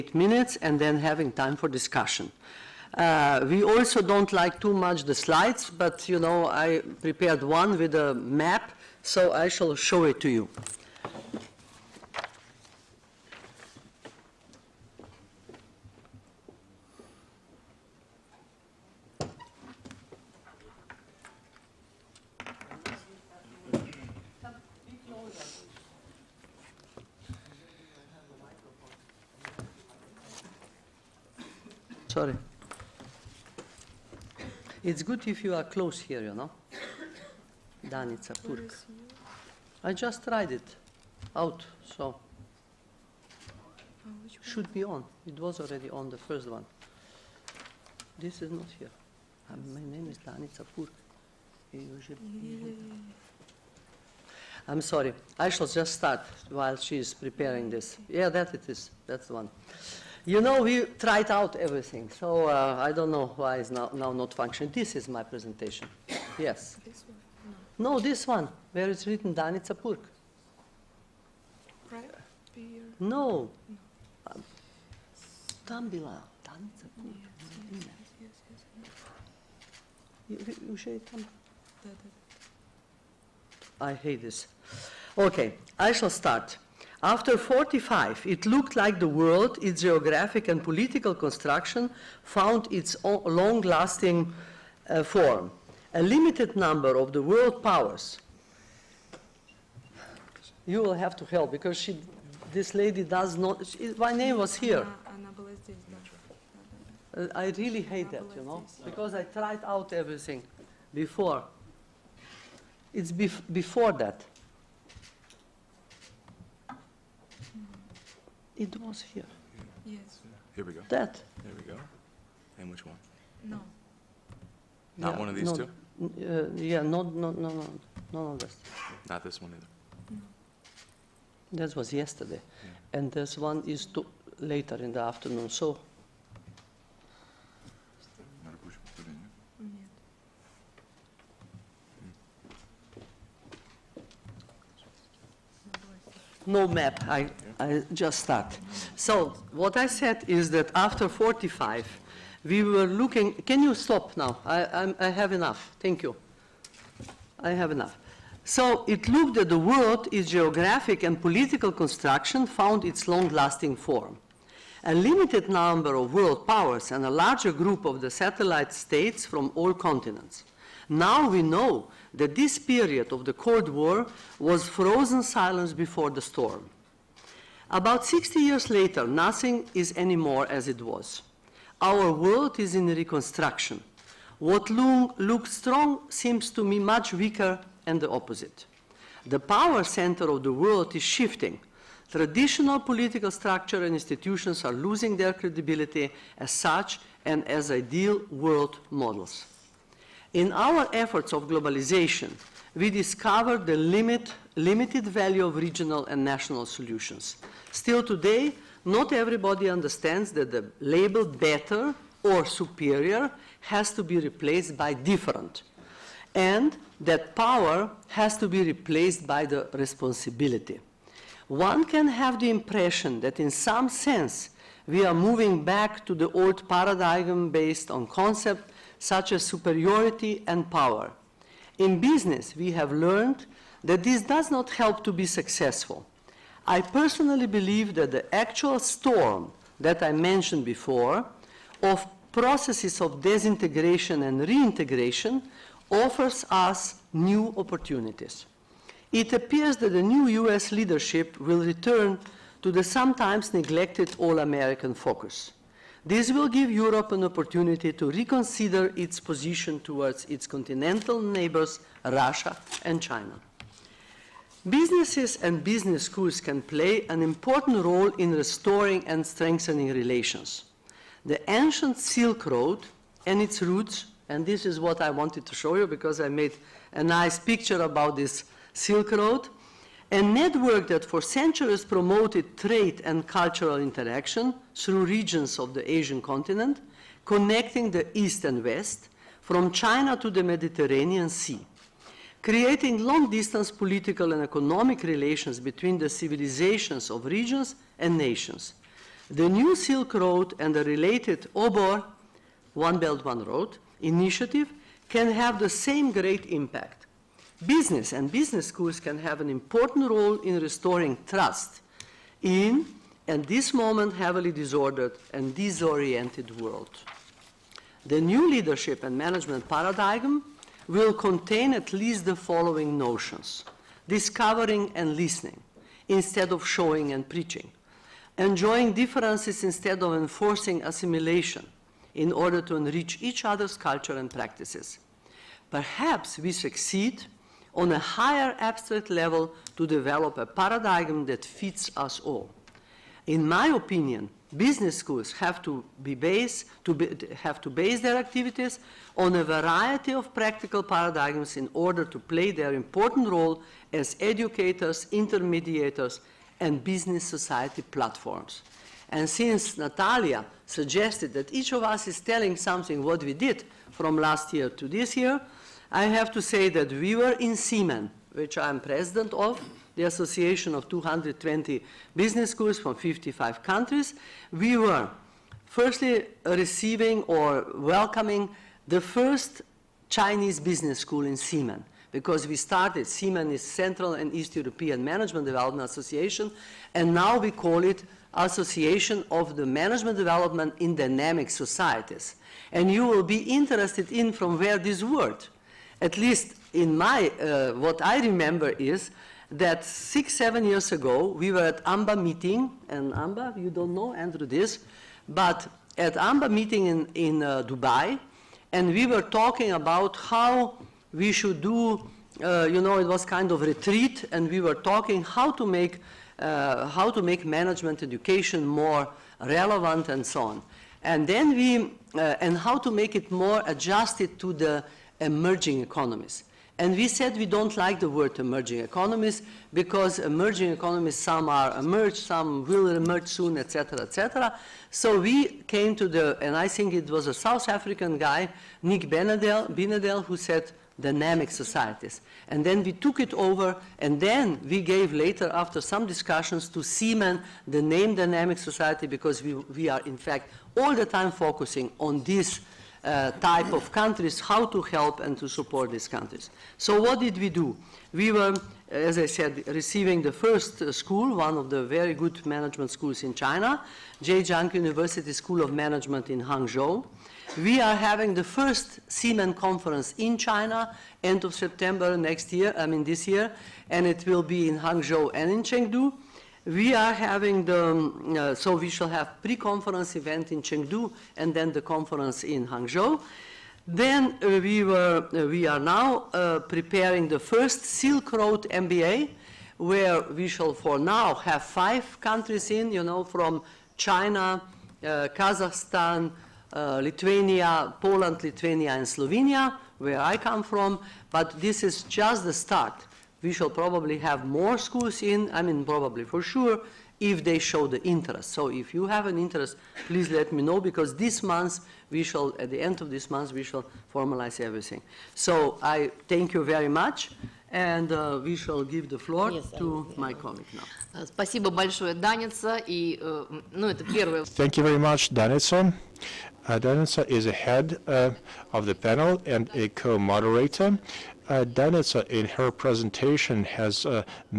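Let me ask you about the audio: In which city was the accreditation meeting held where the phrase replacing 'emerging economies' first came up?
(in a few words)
Dubai.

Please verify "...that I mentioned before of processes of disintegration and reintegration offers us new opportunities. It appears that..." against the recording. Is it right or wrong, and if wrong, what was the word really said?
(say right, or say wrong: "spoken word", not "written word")
right.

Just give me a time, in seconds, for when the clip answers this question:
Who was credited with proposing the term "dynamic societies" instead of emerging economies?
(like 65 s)
438 s.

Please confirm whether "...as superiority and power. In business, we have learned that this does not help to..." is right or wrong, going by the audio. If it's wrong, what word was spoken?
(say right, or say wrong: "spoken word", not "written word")
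right.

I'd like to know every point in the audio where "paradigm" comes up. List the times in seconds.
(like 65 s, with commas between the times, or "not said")
226 s, 319 s, 340 s, 350 s.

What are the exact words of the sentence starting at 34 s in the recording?
it's good if you are close here, you know.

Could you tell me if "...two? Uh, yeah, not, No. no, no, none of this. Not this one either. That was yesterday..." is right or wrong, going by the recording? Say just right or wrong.
right.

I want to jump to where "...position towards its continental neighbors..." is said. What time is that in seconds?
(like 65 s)
259 s.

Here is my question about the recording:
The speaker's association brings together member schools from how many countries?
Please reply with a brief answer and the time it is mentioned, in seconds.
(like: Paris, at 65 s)
55, at 372 s.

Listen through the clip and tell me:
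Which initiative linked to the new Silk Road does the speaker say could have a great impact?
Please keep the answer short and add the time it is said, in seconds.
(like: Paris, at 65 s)
One Belt, One Road, at 301 s.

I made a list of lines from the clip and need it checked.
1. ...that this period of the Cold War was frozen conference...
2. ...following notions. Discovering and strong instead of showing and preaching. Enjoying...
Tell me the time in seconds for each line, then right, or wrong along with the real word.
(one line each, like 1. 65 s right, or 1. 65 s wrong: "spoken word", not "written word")
1. 172 s wrong: "silence", not "conference"
2. 322 s wrong: "listening", not "strong".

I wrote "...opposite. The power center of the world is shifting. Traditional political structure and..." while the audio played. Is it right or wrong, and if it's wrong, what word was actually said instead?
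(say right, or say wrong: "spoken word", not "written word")
right.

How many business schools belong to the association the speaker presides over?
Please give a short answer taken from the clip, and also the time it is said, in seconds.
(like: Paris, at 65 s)
220, at 370 s.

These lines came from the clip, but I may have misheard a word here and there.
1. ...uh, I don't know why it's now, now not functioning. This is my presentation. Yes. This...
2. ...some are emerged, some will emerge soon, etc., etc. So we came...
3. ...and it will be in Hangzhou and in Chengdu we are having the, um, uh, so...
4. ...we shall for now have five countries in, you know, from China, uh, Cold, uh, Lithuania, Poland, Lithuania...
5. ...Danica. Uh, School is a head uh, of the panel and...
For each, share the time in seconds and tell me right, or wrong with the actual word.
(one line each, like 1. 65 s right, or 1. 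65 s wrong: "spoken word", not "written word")
1. 62 s right
2. 431 s right
3. 473 s right
4. 490 s wrong: "Kazakhstan", not "Cold"
5. 525 s wrong: "Danica", not "School".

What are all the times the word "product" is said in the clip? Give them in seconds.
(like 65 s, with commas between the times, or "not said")
not said.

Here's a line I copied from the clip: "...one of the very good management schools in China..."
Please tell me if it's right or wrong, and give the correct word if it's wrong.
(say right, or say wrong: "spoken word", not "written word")
right.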